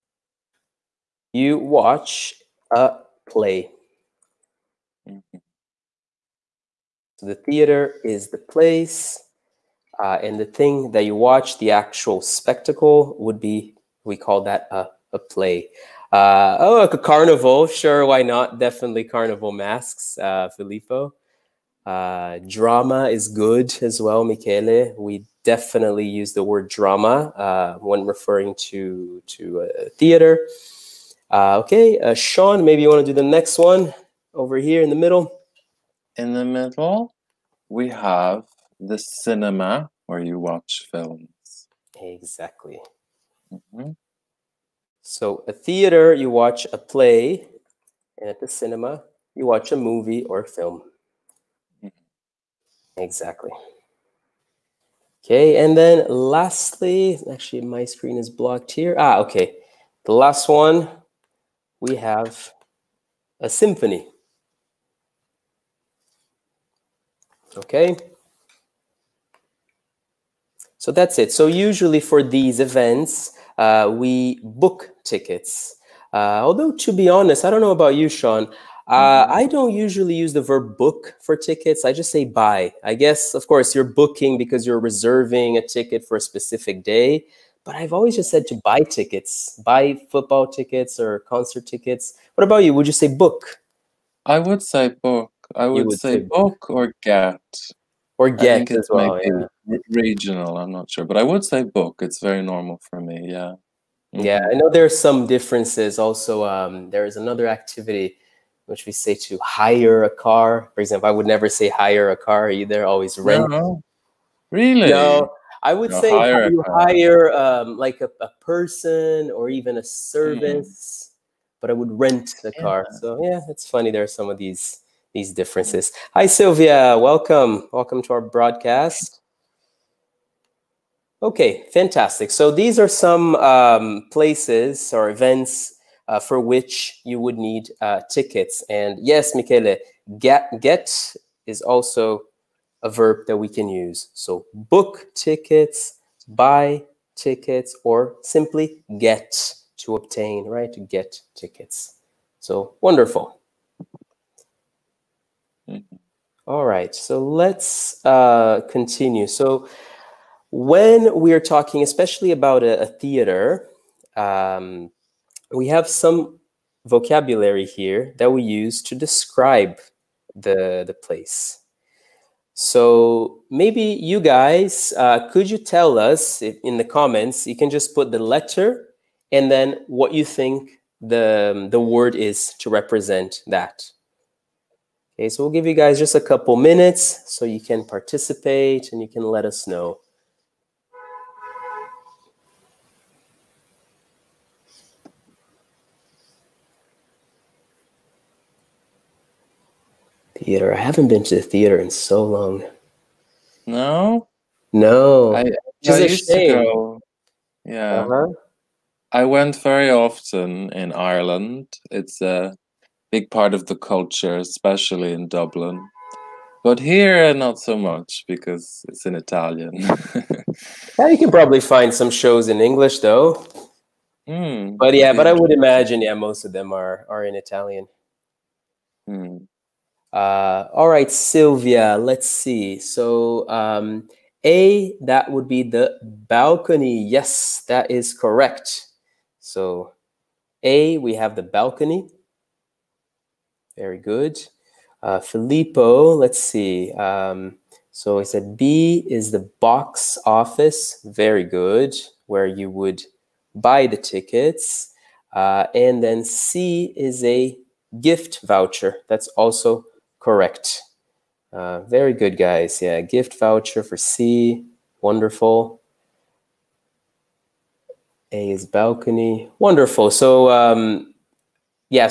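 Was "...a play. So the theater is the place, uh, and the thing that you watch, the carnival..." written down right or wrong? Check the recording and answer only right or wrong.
wrong.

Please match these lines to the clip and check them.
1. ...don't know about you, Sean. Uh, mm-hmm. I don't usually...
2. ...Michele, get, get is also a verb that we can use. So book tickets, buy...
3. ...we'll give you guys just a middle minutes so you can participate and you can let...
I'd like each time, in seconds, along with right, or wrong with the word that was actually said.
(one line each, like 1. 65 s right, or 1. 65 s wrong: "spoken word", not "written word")
1. 77 s right
2. 139 s right
3. 185 s wrong: "couple", not "middle".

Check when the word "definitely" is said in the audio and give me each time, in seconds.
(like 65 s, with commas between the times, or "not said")
18 s, 25 s.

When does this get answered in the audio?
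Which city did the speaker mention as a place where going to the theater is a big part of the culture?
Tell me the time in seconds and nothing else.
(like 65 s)
215 s.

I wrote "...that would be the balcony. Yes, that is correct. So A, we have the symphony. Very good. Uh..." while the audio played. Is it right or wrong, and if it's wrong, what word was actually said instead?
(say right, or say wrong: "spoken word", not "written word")
wrong: "balcony", not "symphony".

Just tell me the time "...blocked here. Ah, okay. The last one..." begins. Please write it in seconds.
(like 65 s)
58 s.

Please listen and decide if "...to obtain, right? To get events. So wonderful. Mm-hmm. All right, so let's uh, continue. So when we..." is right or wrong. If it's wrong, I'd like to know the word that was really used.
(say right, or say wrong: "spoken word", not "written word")
wrong: "tickets", not "events".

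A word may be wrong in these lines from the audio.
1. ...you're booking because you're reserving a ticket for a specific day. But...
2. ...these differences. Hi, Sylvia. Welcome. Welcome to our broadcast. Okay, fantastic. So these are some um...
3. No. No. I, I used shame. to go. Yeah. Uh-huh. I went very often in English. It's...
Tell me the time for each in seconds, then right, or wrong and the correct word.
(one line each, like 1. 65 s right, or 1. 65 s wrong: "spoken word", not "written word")
1. 83 s right
2. 125 s right
3. 203 s wrong: "Ireland", not "English".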